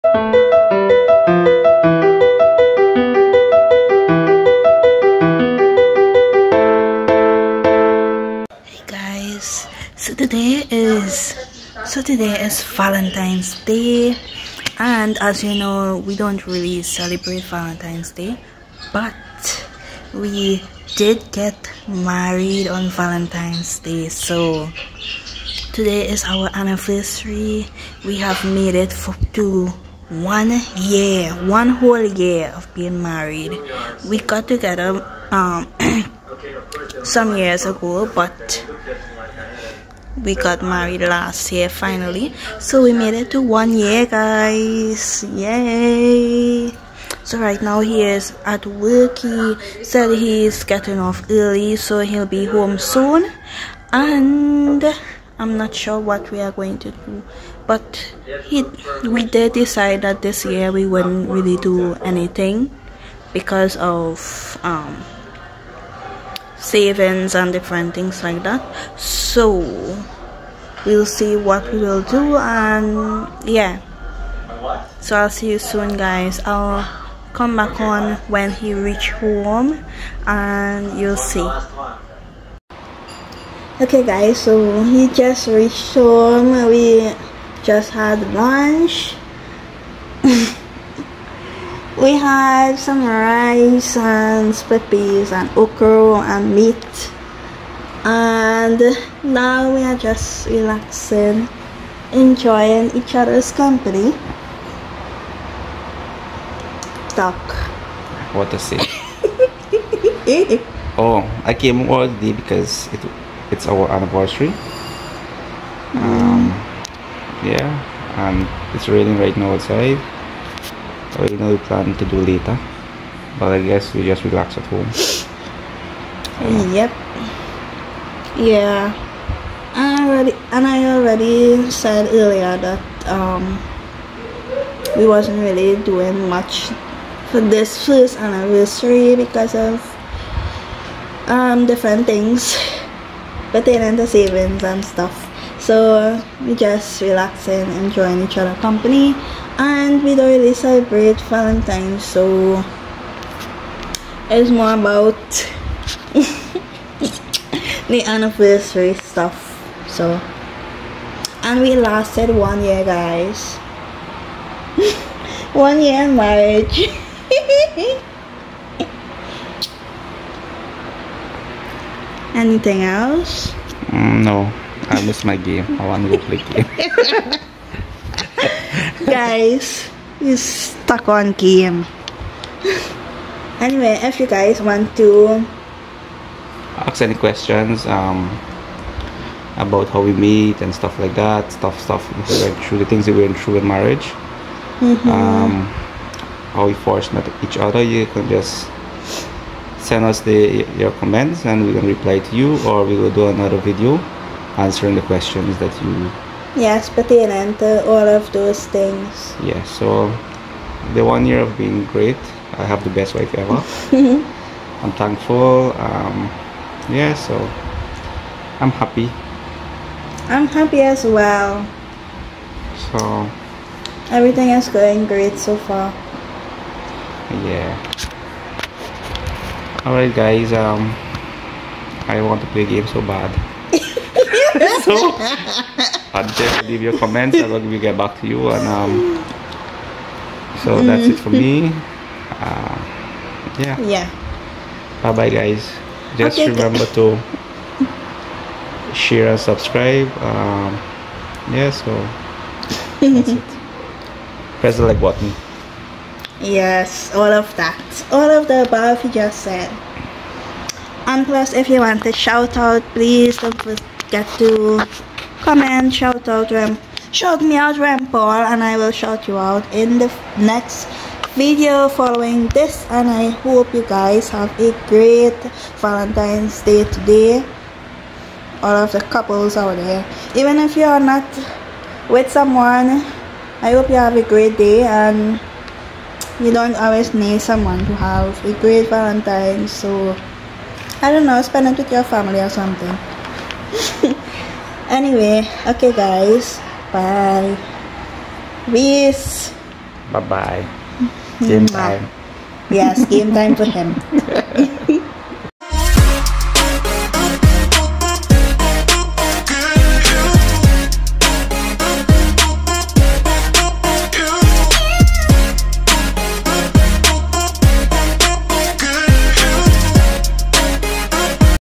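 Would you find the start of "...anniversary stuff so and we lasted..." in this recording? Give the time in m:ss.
2:38.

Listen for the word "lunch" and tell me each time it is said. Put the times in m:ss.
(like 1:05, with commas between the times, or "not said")
1:28.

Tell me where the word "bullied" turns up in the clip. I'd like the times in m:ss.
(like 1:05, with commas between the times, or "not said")
not said.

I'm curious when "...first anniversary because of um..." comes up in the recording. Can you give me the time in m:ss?
2:17.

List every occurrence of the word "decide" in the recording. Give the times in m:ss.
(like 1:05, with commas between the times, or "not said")
0:59.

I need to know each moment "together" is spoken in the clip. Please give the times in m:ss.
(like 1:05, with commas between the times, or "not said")
0:34.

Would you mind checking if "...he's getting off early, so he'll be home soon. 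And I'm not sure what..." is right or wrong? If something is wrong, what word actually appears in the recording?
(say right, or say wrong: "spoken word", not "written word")
right.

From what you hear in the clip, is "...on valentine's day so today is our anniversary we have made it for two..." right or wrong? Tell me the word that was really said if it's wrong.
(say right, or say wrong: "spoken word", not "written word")
right.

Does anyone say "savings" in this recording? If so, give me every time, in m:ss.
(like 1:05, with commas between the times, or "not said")
1:06, 2:24.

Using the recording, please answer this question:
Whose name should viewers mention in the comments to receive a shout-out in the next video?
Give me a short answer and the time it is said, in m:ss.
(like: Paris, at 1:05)
Rem Paul, at 4:27.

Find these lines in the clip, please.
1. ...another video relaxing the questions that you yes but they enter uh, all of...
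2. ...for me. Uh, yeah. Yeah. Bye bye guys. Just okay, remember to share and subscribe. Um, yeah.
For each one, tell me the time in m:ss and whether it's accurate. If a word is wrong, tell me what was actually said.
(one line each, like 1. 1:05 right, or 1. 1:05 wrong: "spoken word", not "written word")
1. 3:23 wrong: "answering", not "relaxing"
2. 4:01 right.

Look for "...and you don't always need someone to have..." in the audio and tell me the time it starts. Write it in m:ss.
4:44.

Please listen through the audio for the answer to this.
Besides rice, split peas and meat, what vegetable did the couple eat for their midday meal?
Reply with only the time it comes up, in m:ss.
1:35.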